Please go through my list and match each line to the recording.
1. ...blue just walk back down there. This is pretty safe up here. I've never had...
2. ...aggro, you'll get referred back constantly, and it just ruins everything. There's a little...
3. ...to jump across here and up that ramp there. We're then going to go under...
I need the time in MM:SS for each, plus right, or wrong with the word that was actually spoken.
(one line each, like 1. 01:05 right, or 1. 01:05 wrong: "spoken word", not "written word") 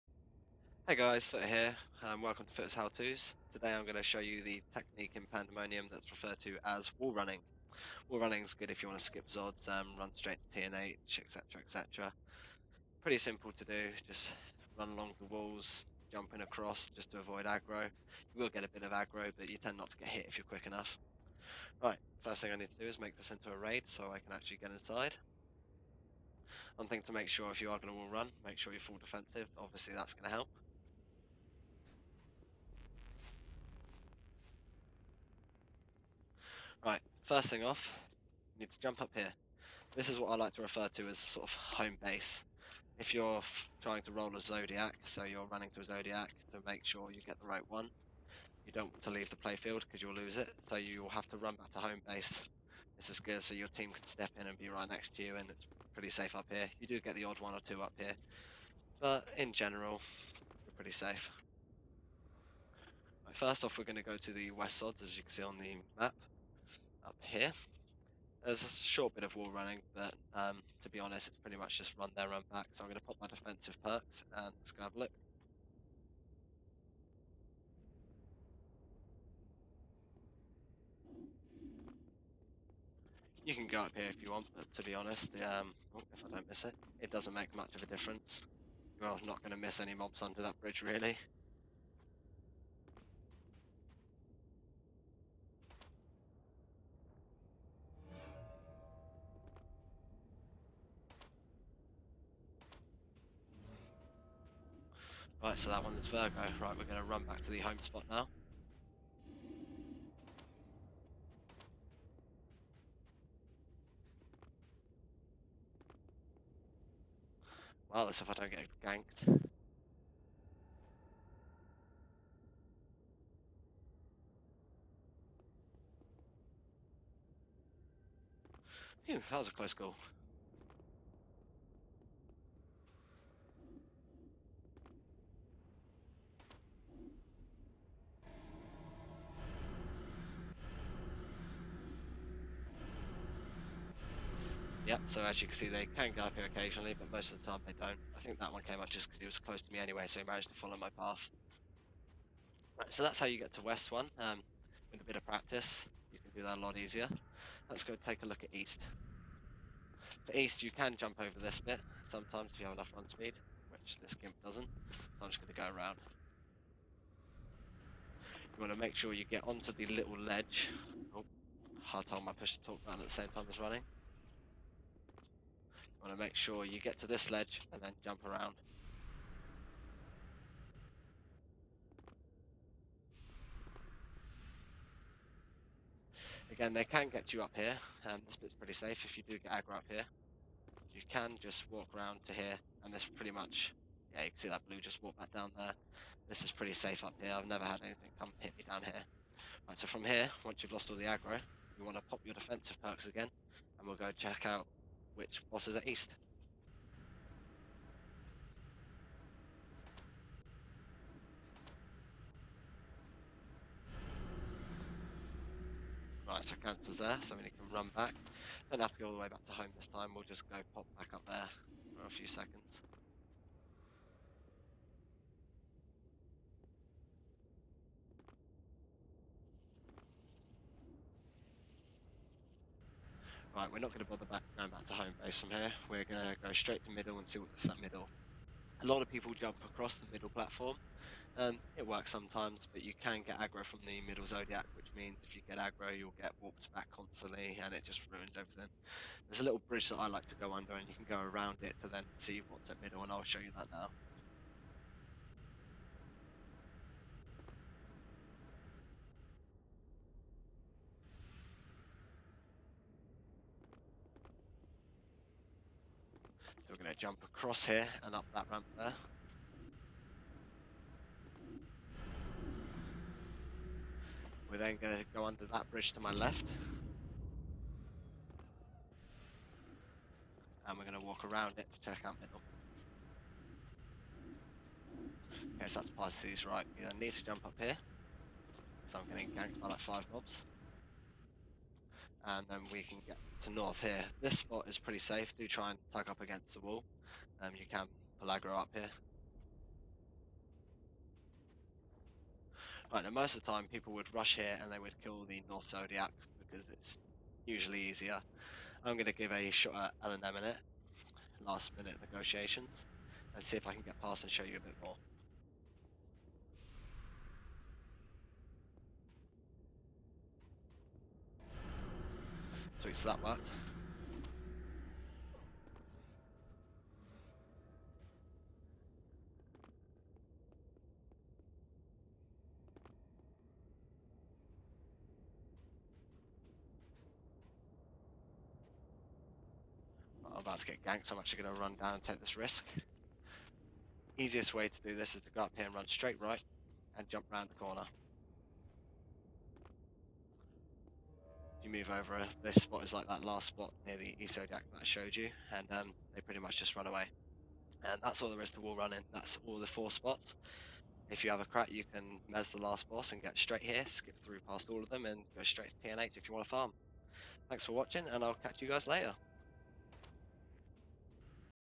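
1. 03:14 right
2. 04:05 wrong: "warped", not "referred"
3. 04:26 right.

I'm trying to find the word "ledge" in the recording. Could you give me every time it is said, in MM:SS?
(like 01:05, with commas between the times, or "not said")
02:50, 02:57.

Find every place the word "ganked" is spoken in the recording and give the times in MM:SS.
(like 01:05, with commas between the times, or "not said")
01:58, 04:49, 05:40.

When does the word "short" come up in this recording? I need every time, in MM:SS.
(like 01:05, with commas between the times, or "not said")
01:08.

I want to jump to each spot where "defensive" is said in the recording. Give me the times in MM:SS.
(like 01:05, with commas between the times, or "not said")
00:28, 01:13, 03:22.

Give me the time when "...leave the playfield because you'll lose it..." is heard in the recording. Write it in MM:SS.
00:49.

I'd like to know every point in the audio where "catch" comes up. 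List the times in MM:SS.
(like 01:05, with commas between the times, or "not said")
06:08.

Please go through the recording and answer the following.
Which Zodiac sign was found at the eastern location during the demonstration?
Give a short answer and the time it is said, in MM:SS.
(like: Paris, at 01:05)
Cancer, at 03:36.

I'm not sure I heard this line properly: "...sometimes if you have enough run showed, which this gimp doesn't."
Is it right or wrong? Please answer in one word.
wrong.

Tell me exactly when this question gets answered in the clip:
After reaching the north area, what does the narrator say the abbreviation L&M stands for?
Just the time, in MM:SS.
05:11.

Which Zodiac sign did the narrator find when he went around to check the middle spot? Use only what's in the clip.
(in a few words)
Pisces.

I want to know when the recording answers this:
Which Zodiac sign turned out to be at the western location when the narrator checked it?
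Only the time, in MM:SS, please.
01:46.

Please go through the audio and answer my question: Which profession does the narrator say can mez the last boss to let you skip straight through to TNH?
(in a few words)
crat.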